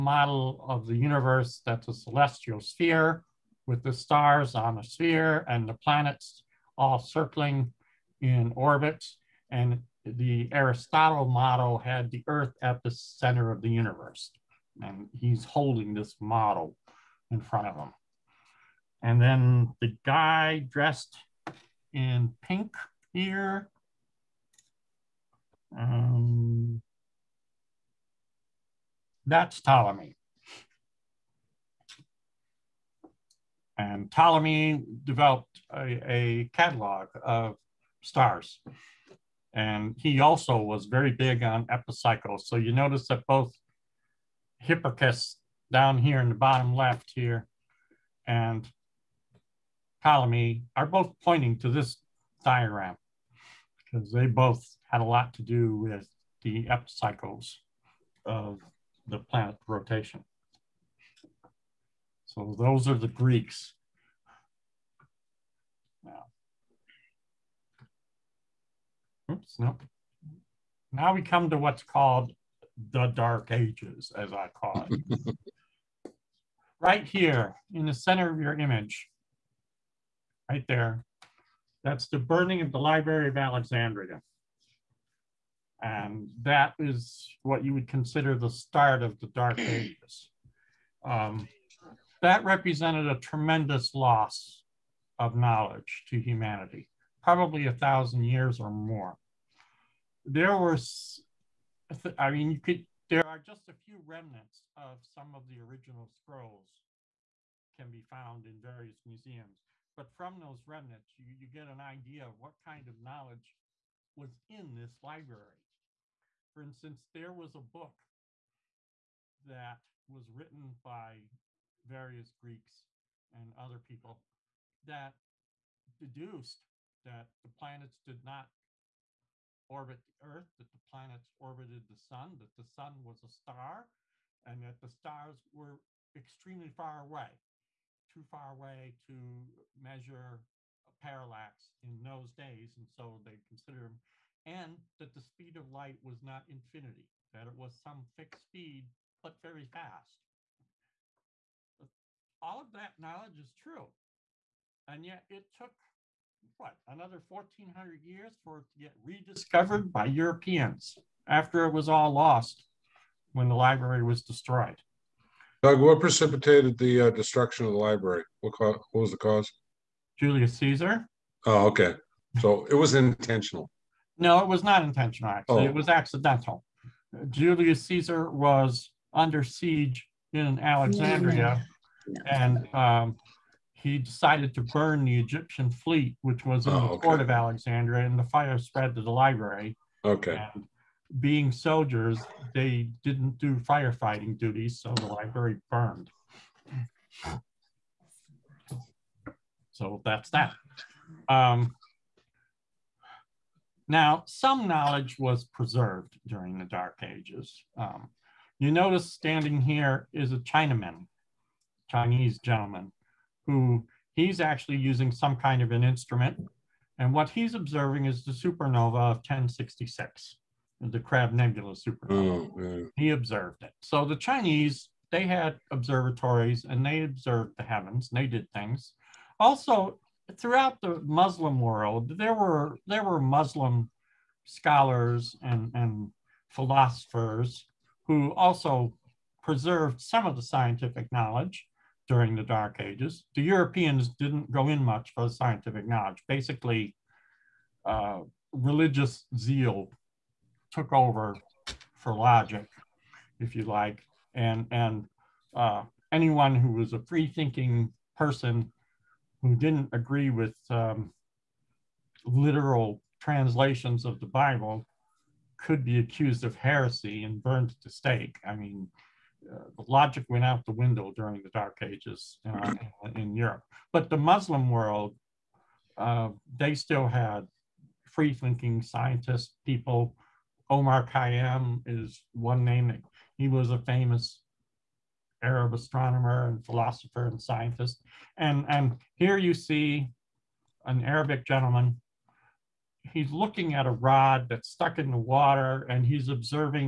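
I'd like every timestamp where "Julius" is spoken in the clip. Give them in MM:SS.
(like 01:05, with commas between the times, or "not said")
02:50, 02:57.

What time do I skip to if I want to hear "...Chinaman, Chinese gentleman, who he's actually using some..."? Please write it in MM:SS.
03:30.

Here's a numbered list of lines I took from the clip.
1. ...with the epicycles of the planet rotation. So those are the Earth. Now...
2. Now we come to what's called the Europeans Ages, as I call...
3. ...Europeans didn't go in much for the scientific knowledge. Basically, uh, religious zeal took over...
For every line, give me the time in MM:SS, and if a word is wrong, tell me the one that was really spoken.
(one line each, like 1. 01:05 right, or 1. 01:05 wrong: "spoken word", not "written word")
1. 00:55 wrong: "Greeks", not "Earth"
2. 01:10 wrong: "Dark", not "Europeans"
3. 04:03 right.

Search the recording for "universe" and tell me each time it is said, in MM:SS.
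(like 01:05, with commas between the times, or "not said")
00:00, 00:13.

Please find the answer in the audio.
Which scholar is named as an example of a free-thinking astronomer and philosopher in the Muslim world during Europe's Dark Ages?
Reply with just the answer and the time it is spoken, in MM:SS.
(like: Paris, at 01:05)
Omar Khayyam, at 04:40.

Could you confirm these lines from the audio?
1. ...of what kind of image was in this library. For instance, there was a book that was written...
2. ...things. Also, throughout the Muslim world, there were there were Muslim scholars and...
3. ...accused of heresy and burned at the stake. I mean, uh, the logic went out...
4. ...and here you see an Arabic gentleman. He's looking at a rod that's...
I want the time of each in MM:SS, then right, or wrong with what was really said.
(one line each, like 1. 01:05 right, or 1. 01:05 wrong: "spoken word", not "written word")
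1. 01:52 wrong: "knowledge", not "image"
2. 03:48 right
3. 04:25 right
4. 04:48 right.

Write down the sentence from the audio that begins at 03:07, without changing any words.
port of Alexandria, and the fire spread to the library.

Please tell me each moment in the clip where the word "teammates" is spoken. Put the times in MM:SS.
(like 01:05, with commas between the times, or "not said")
not said.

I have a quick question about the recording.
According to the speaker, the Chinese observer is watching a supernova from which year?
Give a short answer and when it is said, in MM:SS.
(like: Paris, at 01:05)
1066, at 03:39.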